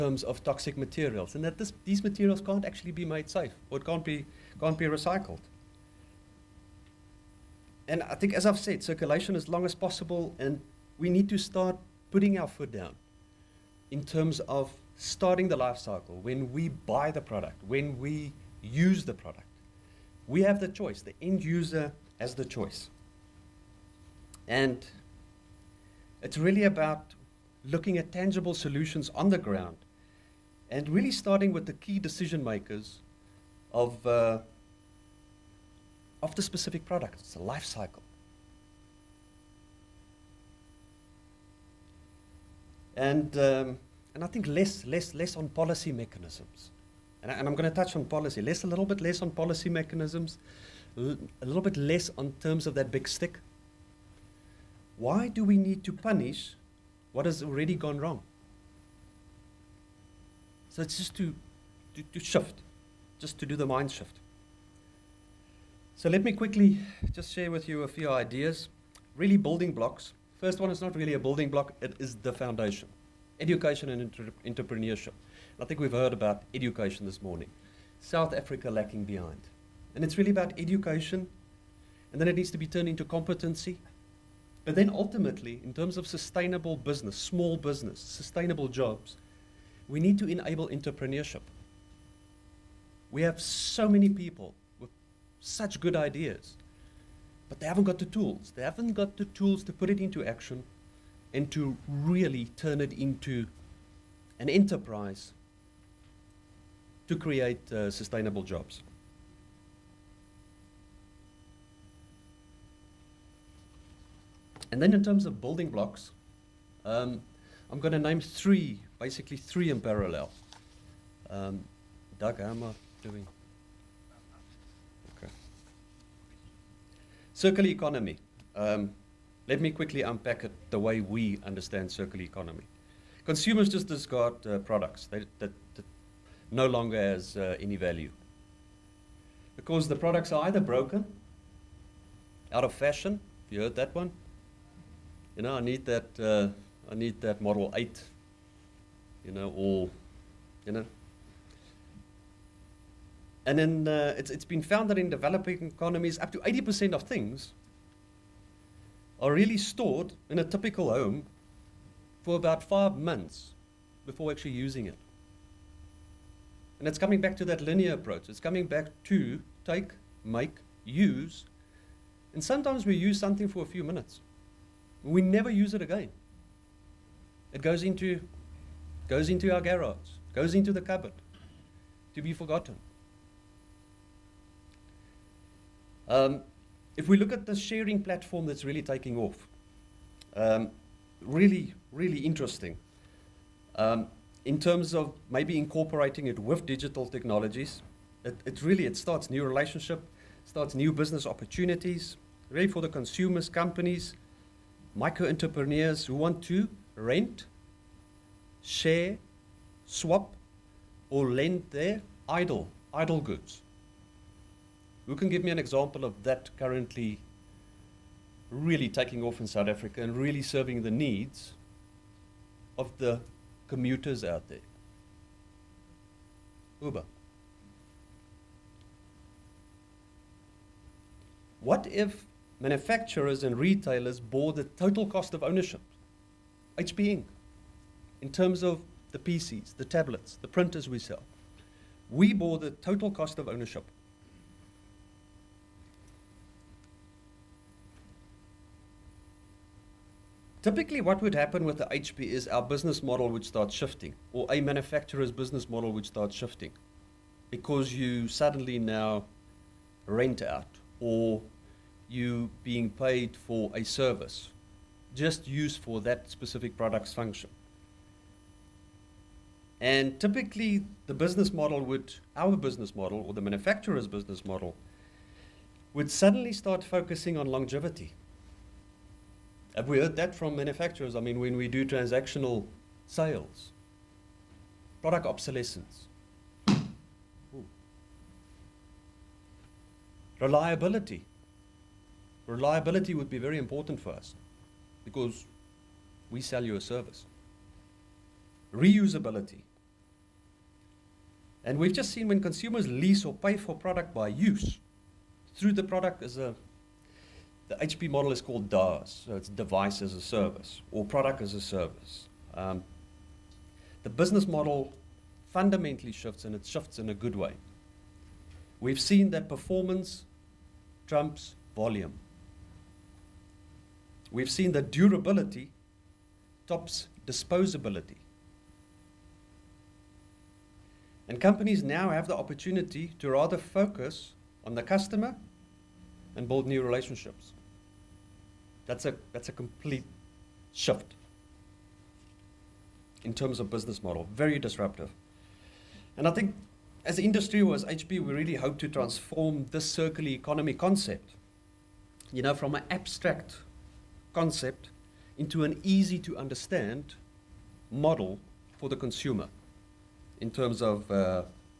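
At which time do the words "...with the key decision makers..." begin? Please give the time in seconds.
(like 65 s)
31 s.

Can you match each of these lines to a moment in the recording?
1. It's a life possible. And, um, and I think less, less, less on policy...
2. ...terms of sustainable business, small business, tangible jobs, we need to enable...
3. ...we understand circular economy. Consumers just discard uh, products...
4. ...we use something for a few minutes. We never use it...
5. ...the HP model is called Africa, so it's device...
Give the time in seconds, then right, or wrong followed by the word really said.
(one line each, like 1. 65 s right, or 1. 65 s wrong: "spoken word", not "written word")
1. 37 s wrong: "cycle", not "possible"
2. 85 s wrong: "sustainable", not "tangible"
3. 130 s right
4. 172 s right
5. 307 s wrong: "DaaS", not "Africa".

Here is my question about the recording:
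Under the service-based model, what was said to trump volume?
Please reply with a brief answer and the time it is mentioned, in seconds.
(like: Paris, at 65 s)
Performance, at 319 s.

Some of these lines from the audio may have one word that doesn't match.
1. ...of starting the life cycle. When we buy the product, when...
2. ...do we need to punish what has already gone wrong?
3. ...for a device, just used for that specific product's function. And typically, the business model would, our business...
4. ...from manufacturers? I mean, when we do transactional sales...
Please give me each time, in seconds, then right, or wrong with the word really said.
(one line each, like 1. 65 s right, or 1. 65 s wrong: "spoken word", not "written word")
1. 14 s right
2. 55 s right
3. 263 s wrong: "service", not "device"
4. 280 s right.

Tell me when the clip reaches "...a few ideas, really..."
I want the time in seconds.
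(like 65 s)
67 s.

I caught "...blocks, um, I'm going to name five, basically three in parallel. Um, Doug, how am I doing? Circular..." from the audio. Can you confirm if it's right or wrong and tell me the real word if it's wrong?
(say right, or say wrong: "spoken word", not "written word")
wrong: "three", not "five".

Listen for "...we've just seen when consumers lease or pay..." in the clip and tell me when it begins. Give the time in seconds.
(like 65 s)
301 s.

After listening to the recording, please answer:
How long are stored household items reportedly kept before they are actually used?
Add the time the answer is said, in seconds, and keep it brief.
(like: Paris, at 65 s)
5 months, at 162 s.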